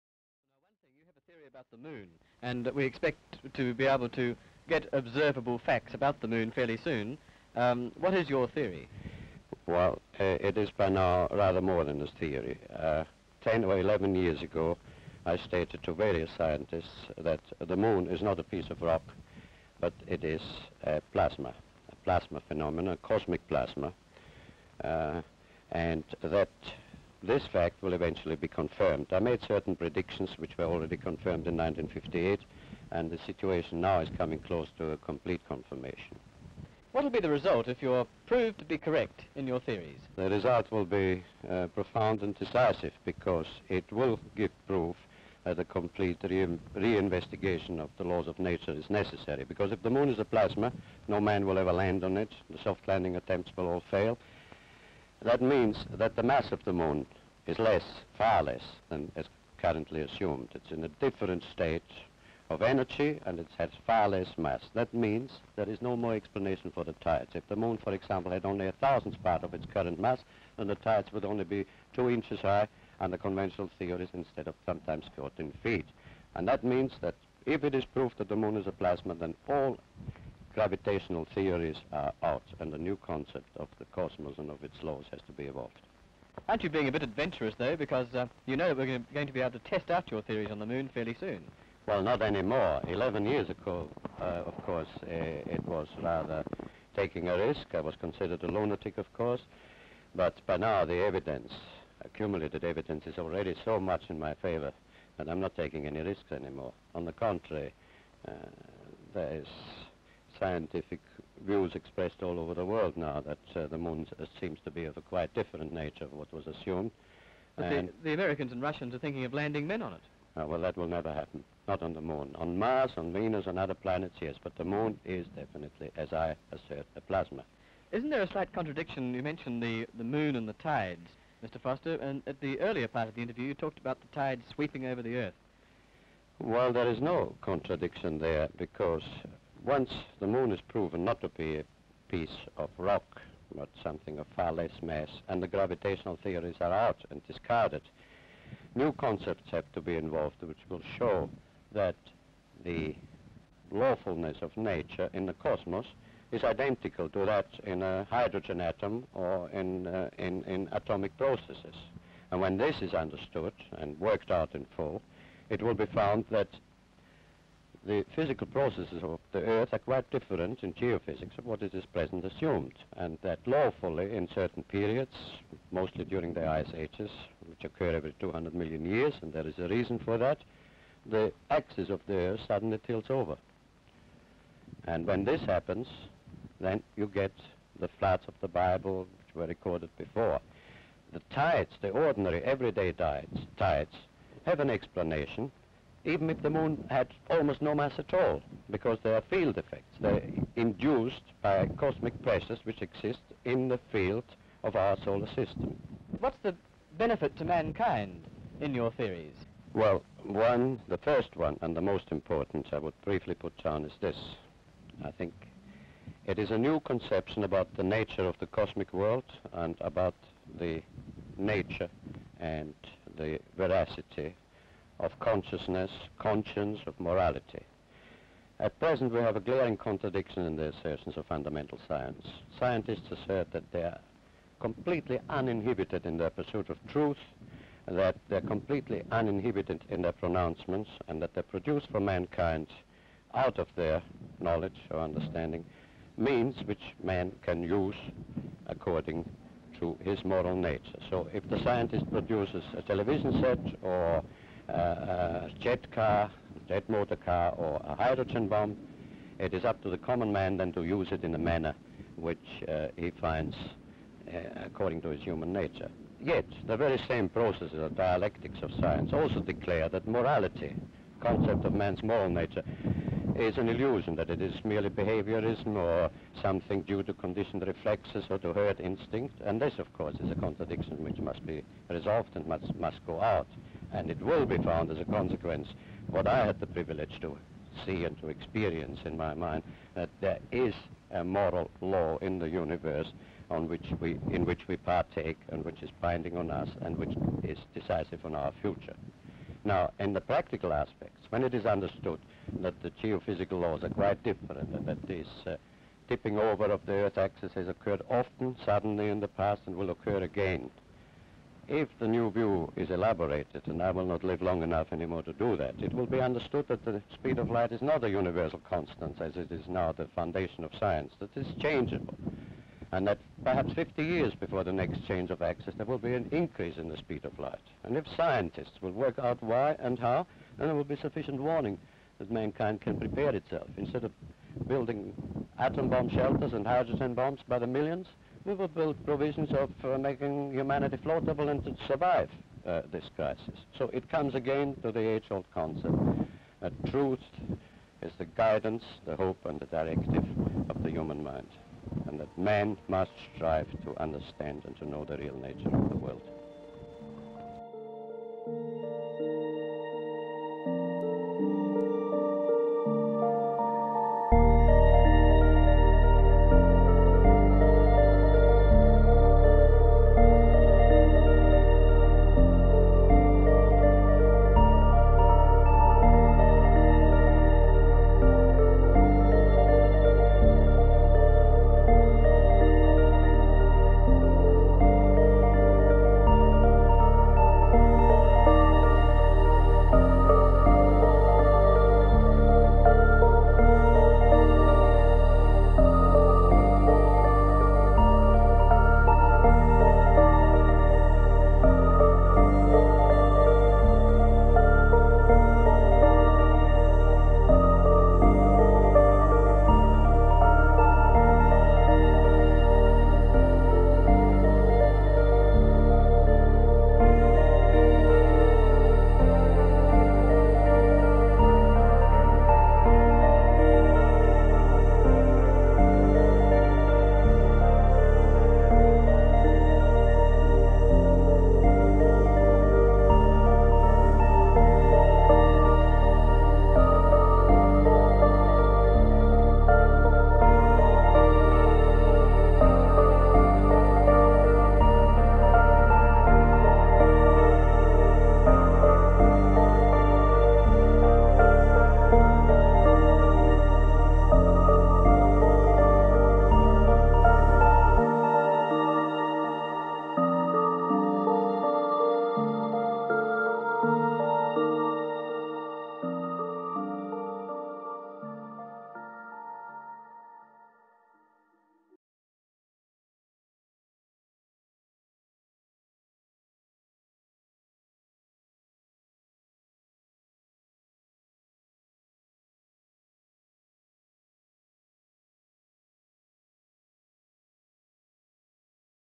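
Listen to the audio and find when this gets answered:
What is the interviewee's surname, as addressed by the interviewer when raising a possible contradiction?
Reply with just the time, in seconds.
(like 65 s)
131 s.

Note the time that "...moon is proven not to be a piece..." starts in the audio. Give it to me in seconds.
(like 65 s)
140 s.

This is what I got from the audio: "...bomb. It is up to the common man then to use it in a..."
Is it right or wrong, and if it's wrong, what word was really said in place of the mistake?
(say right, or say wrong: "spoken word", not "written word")
right.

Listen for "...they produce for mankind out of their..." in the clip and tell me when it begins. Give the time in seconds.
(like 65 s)
241 s.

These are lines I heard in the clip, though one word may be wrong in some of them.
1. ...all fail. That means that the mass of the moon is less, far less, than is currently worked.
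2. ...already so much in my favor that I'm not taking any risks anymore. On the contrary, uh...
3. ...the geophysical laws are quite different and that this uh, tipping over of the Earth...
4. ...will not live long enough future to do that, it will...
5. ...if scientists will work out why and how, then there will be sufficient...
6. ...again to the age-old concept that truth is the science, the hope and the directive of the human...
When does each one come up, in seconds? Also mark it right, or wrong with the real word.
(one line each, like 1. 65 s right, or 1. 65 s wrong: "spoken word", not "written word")
1. 53 s wrong: "assumed", not "worked"
2. 103 s right
3. 302 s right
4. 313 s wrong: "anymore", not "future"
5. 327 s right
6. 344 s wrong: "guidance", not "science".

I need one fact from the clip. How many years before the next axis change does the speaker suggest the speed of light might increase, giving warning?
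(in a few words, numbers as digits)
50 years.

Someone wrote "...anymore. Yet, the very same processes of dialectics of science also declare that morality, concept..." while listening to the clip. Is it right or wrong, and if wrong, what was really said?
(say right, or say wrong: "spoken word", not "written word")
wrong: "nature", not "anymore".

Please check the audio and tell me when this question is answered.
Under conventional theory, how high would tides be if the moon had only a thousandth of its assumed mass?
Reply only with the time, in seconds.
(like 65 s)
71 s.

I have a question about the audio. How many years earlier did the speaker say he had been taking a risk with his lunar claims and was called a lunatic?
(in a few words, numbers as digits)
11.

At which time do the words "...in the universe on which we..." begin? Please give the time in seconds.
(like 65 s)
292 s.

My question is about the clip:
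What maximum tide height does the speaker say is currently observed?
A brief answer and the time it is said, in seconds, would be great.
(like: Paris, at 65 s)
14 feet, at 75 s.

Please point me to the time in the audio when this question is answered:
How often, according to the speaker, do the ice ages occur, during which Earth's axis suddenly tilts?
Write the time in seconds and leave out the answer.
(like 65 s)
177 s.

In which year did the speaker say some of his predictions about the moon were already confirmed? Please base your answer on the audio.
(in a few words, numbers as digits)
1958.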